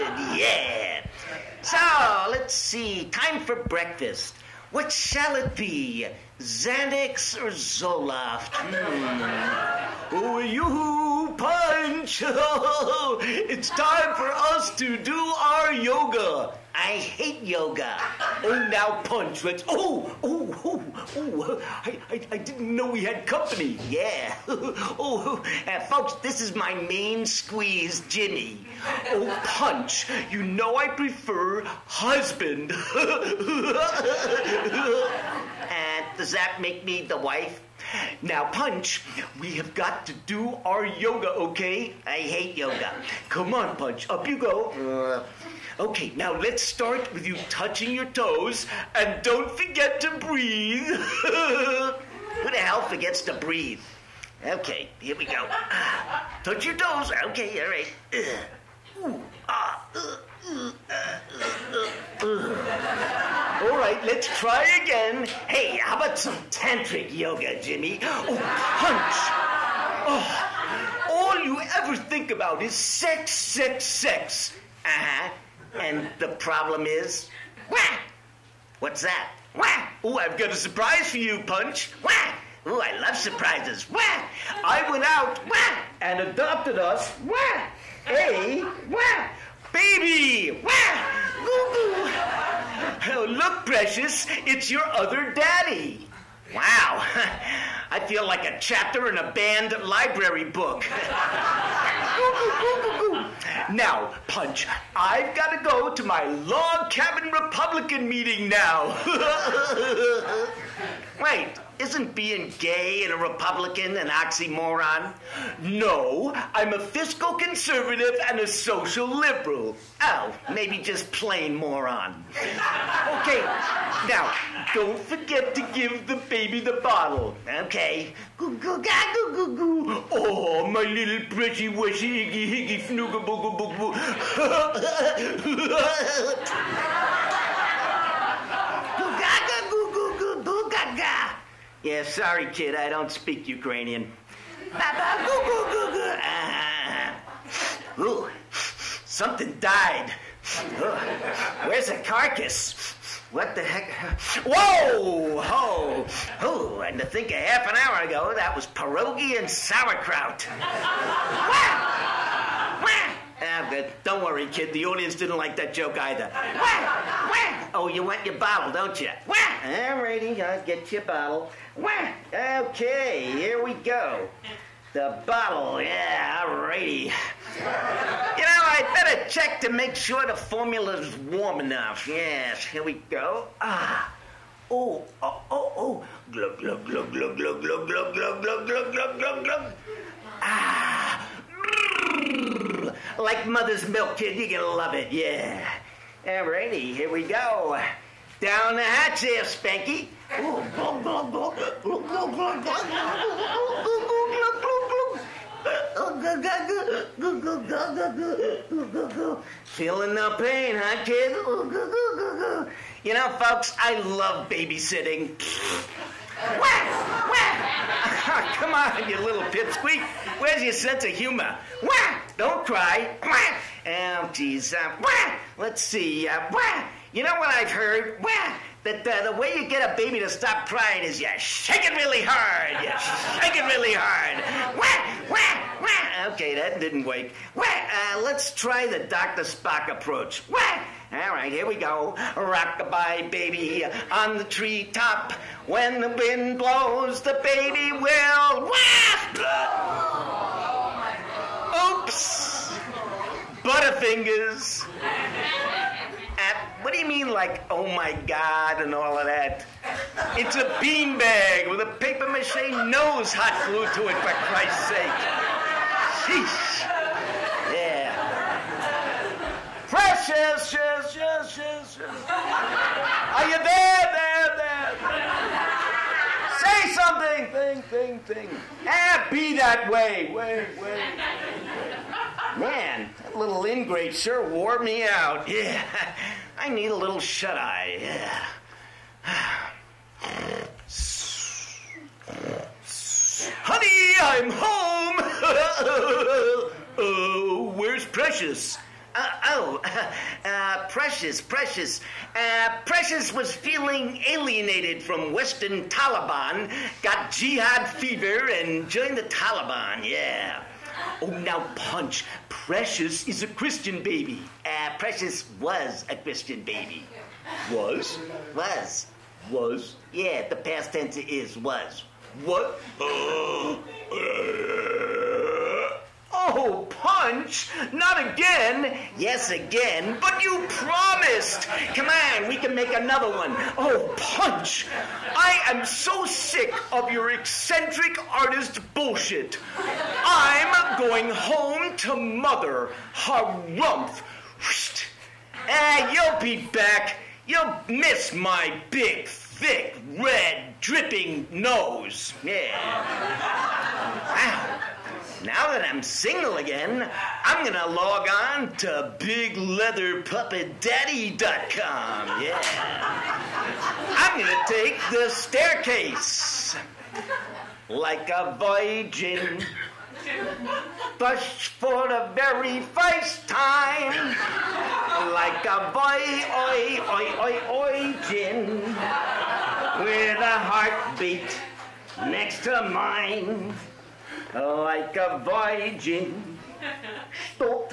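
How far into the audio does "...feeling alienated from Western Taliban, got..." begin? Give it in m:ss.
5:03.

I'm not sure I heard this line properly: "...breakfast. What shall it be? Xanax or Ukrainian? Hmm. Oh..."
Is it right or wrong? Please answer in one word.
wrong.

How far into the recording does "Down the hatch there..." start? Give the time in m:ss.
3:18.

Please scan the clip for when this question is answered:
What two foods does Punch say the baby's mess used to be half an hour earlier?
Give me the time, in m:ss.
2:38.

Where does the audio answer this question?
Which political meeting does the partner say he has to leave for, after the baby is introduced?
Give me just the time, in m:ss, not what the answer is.
1:46.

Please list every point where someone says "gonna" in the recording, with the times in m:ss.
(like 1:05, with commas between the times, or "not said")
5:57, 6:04.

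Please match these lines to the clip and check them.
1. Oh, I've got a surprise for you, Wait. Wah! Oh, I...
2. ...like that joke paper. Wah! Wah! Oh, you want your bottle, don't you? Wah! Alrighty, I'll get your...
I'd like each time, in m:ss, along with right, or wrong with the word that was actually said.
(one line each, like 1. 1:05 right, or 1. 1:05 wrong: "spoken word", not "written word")
1. 1:20 wrong: "Punch", not "Wait"
2. 2:45 wrong: "either", not "paper".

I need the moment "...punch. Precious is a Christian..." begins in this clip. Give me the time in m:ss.
5:11.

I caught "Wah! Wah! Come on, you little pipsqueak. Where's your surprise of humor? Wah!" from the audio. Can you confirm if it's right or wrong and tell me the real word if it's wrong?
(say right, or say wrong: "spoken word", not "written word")
wrong: "sense", not "surprise".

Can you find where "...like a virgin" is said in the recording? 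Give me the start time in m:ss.
6:07.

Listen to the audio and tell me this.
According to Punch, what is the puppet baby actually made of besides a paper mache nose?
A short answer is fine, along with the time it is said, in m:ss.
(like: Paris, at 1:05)
A beanbag, at 4:20.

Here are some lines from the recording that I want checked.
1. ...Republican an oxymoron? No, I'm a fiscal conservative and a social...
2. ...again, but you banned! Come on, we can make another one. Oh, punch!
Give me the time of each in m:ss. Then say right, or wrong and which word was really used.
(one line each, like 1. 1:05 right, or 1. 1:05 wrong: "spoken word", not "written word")
1. 1:53 right
2. 5:29 wrong: "promised", not "banned".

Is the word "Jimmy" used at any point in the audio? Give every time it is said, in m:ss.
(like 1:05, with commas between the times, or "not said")
0:28, 1:07.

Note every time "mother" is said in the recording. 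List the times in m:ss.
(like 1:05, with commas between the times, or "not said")
3:13, 5:42.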